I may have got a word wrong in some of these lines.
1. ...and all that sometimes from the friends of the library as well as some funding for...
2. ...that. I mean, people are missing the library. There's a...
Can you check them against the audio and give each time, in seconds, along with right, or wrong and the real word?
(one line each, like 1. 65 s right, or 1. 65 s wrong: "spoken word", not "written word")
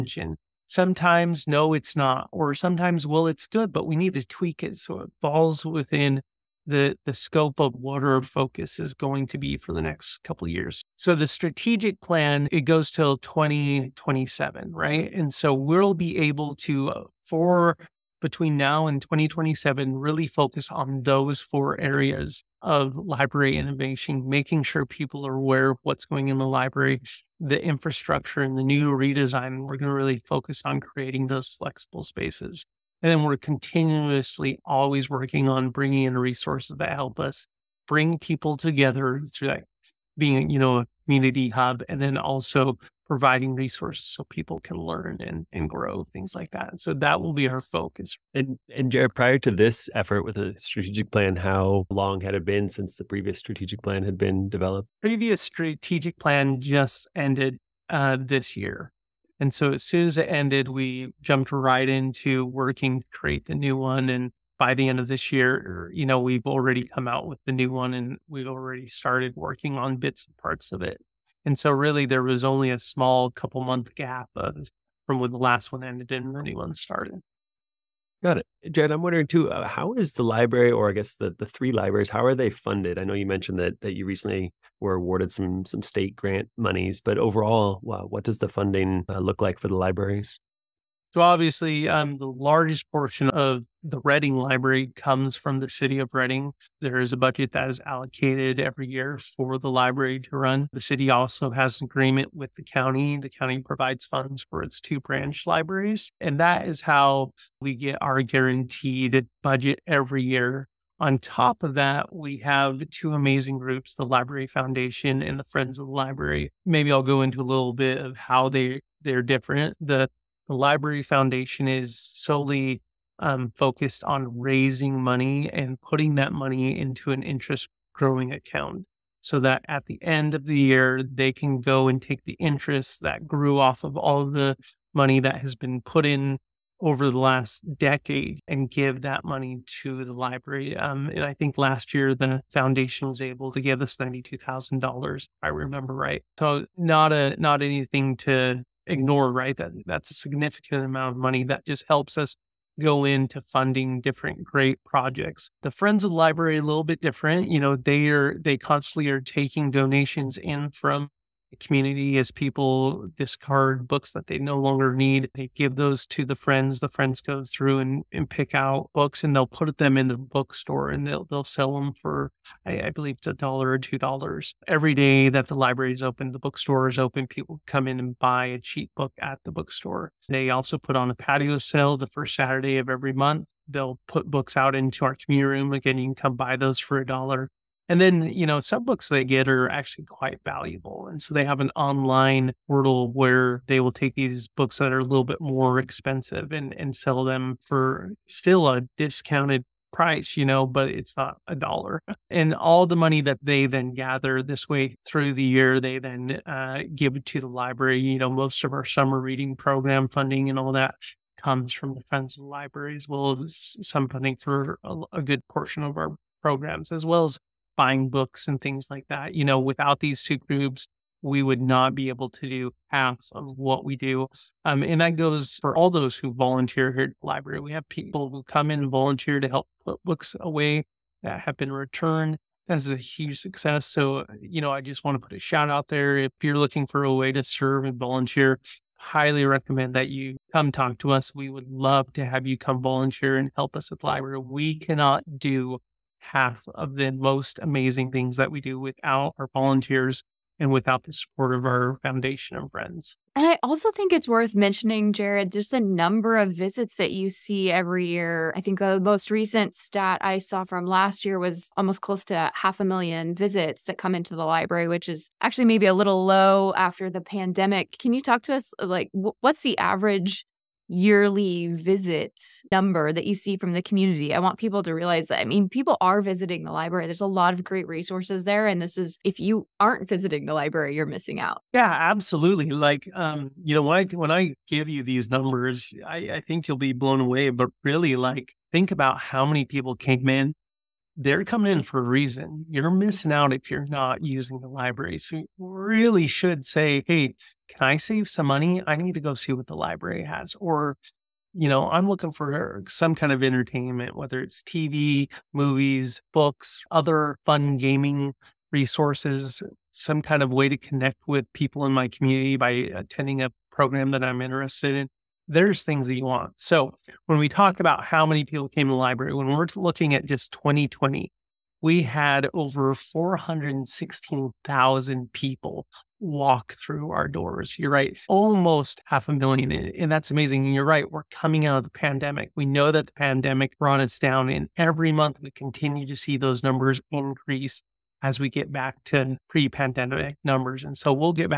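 1. 210 s wrong: "comes", not "sometimes"
2. 275 s wrong: "visiting", not "missing".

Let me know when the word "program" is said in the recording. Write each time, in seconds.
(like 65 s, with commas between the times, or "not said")
209 s, 216 s, 313 s.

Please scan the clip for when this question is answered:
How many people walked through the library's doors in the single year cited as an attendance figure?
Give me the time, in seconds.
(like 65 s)
322 s.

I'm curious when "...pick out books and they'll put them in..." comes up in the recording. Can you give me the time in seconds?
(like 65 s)
168 s.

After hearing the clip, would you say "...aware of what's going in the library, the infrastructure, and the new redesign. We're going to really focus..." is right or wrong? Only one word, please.
right.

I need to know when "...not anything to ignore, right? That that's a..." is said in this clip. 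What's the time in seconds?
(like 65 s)
147 s.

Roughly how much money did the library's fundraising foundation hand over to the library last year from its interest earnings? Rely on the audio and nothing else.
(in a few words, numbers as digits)
$92,000.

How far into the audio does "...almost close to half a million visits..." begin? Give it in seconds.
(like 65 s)
261 s.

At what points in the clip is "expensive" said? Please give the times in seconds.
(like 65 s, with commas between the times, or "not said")
195 s.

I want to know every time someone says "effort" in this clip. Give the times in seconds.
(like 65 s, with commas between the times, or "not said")
49 s.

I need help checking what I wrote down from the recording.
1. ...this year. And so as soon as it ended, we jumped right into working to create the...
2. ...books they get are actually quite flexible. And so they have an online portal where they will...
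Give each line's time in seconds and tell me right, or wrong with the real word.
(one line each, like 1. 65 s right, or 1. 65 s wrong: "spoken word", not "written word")
1. 58 s right
2. 188 s wrong: "valuable", not "flexible".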